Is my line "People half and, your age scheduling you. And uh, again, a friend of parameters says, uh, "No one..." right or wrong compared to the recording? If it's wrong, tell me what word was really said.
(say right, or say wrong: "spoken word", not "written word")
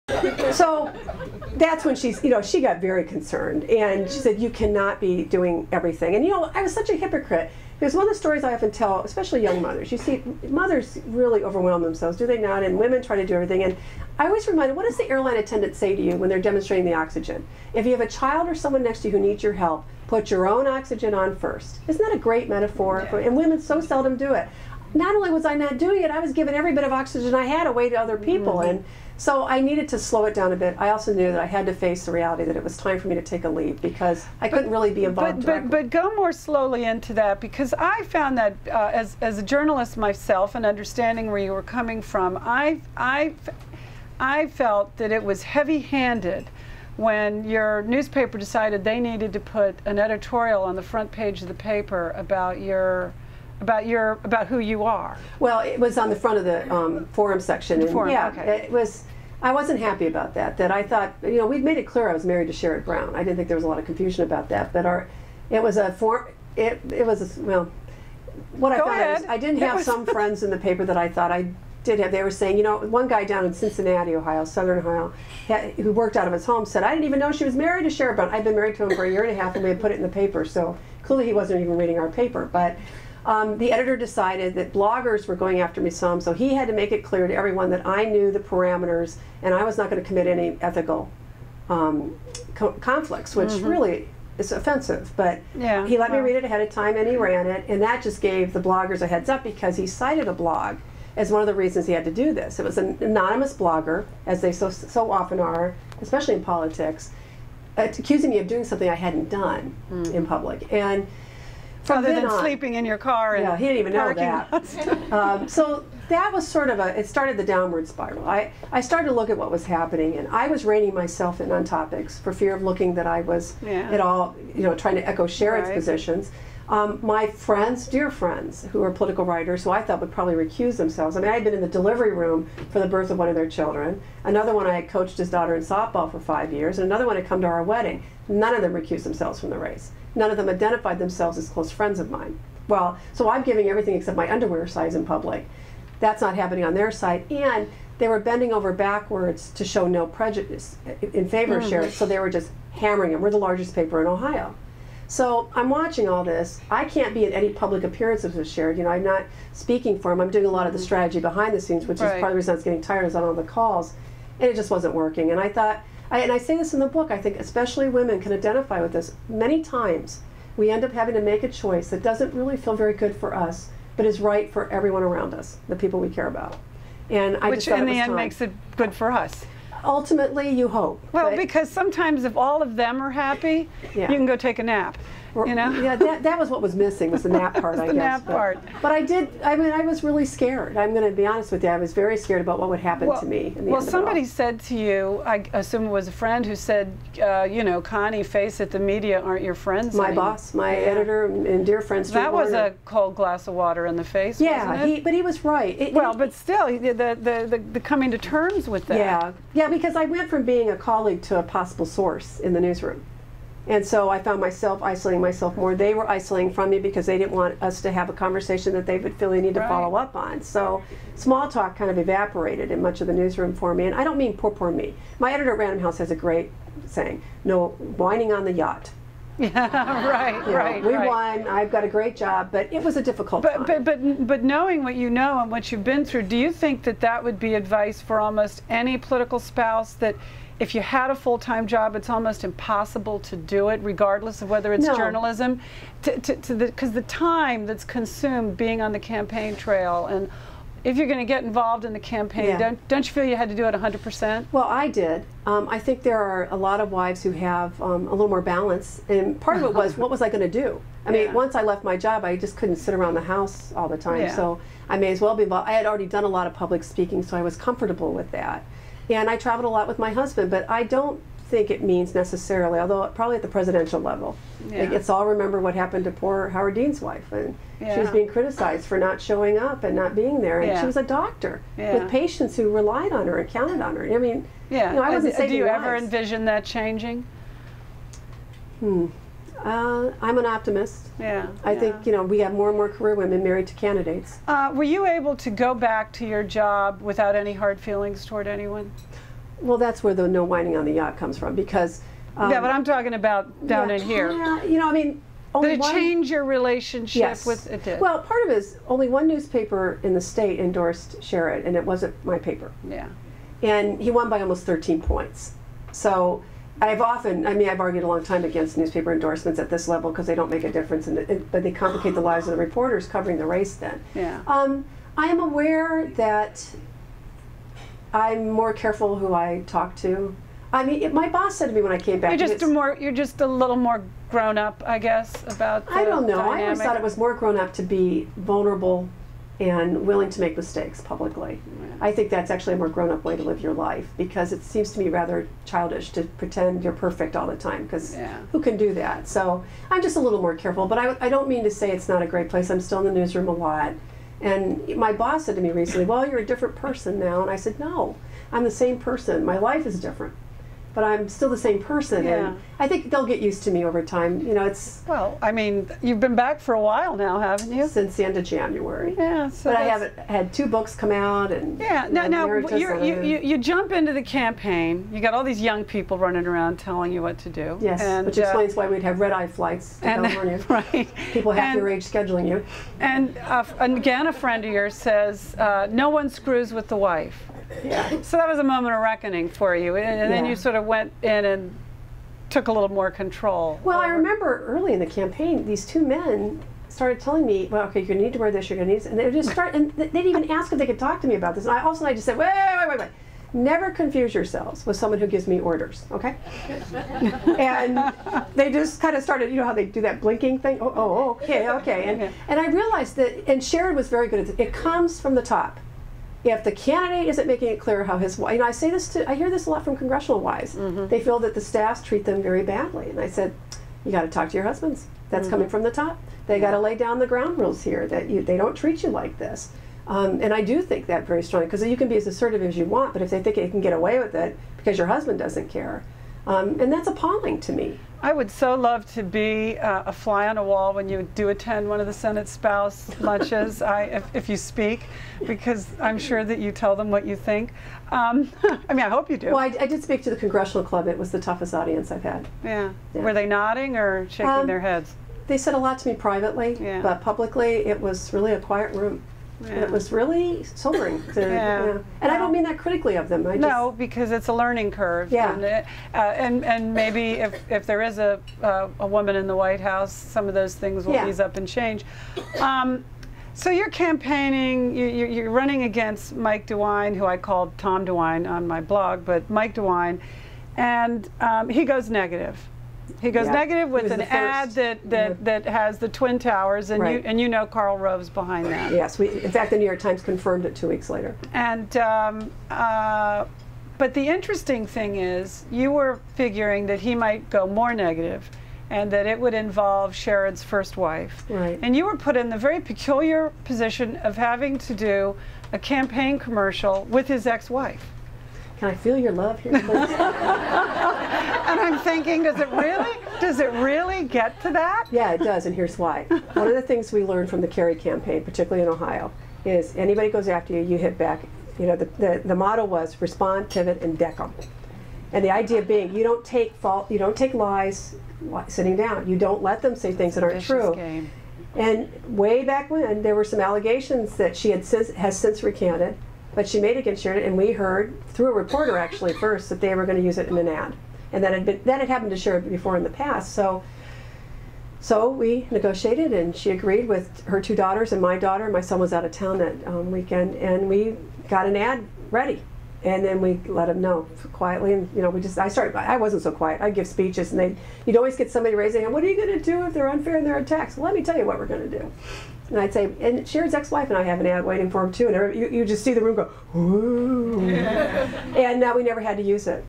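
wrong: "yours", not "parameters".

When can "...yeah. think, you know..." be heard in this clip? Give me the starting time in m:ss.
4:51.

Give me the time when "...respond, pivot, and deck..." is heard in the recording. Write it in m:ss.
8:43.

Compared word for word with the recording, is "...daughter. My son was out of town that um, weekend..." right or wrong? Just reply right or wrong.
right.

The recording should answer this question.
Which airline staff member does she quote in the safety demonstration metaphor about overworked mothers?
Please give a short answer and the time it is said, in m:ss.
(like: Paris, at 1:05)
airline attendant, at 0:15.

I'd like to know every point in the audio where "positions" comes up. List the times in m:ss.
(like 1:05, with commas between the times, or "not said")
2:05, 8:23.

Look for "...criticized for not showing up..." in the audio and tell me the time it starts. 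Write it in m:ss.
4:38.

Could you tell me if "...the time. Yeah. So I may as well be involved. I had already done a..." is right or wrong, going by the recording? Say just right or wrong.
right.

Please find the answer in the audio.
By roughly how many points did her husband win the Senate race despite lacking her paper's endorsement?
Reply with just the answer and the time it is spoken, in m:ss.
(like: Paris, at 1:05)
13, at 5:14.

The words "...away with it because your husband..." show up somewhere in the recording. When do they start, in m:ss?
7:13.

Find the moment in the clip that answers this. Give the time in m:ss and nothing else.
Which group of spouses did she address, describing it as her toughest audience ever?
7:30.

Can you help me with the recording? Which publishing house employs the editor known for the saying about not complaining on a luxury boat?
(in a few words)
Random House.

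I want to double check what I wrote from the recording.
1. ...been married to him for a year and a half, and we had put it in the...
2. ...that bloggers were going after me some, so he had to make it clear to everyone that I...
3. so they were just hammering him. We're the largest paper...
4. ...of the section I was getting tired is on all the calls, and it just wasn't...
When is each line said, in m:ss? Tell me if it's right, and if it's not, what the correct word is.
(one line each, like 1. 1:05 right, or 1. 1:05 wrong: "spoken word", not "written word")
1. 1:18 right
2. 1:24 right
3. 2:31 right
4. 2:42 wrong: "reason", not "section".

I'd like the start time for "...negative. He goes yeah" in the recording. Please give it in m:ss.
8:02.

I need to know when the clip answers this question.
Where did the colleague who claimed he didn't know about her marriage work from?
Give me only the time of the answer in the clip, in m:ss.
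1:13.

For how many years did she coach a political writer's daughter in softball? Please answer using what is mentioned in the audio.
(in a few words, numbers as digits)
5.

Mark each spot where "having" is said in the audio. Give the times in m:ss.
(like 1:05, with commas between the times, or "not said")
2:50, 8:24.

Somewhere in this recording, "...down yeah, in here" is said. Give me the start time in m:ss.
5:03.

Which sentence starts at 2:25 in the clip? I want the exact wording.
That's not happening on their side.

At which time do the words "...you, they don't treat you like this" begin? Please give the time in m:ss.
7:08.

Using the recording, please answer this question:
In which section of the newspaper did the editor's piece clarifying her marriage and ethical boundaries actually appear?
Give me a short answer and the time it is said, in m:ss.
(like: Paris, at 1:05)
forum section, at 0:57.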